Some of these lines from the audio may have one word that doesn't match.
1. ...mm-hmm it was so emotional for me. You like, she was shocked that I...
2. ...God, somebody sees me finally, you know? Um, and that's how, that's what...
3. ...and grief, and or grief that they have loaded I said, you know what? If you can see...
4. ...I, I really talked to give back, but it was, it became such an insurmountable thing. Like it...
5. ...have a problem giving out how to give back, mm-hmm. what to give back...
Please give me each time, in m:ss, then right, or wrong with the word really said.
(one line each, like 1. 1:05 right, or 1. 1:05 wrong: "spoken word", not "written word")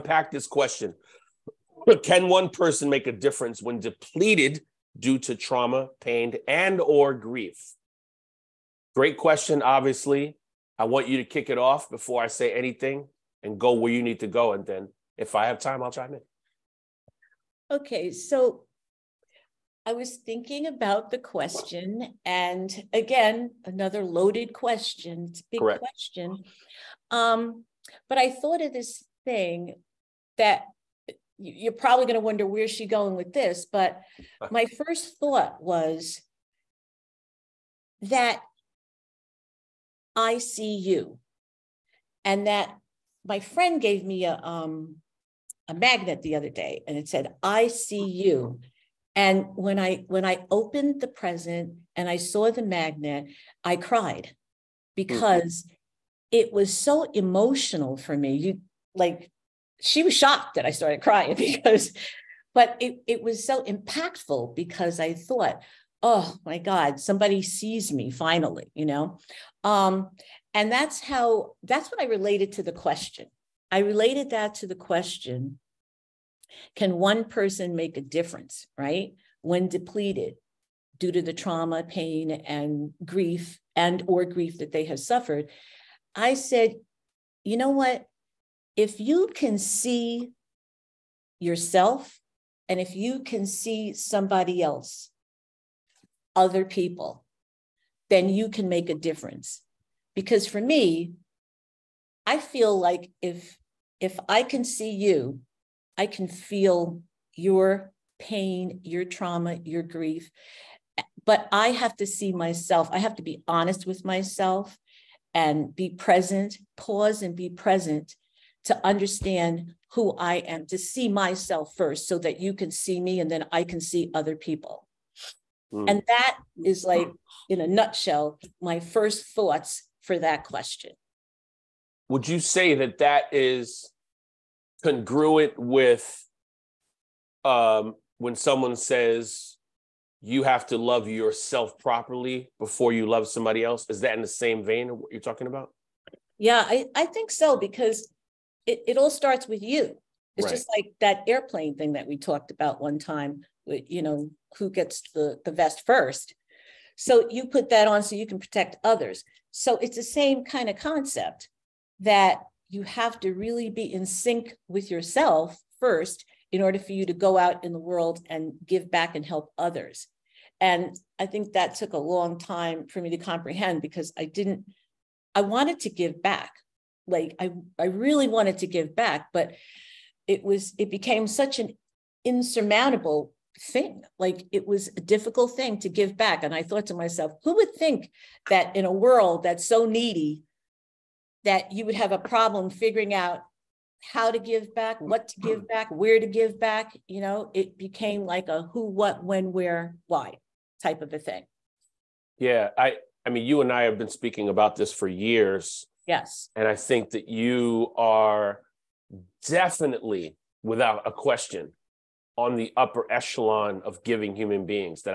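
1. 0:55 right
2. 1:06 right
3. 1:22 wrong: "suffered", not "loaded"
4. 2:57 wrong: "wanted", not "talked"
5. 3:11 wrong: "figuring", not "giving".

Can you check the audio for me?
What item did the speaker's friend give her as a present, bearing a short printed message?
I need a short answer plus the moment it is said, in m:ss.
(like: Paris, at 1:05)
A magnet, at 0:45.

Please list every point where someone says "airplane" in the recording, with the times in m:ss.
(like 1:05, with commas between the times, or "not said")
2:31.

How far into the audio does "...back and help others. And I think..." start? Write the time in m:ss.
2:48.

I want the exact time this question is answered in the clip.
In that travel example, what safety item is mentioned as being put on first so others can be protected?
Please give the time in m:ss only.
2:35.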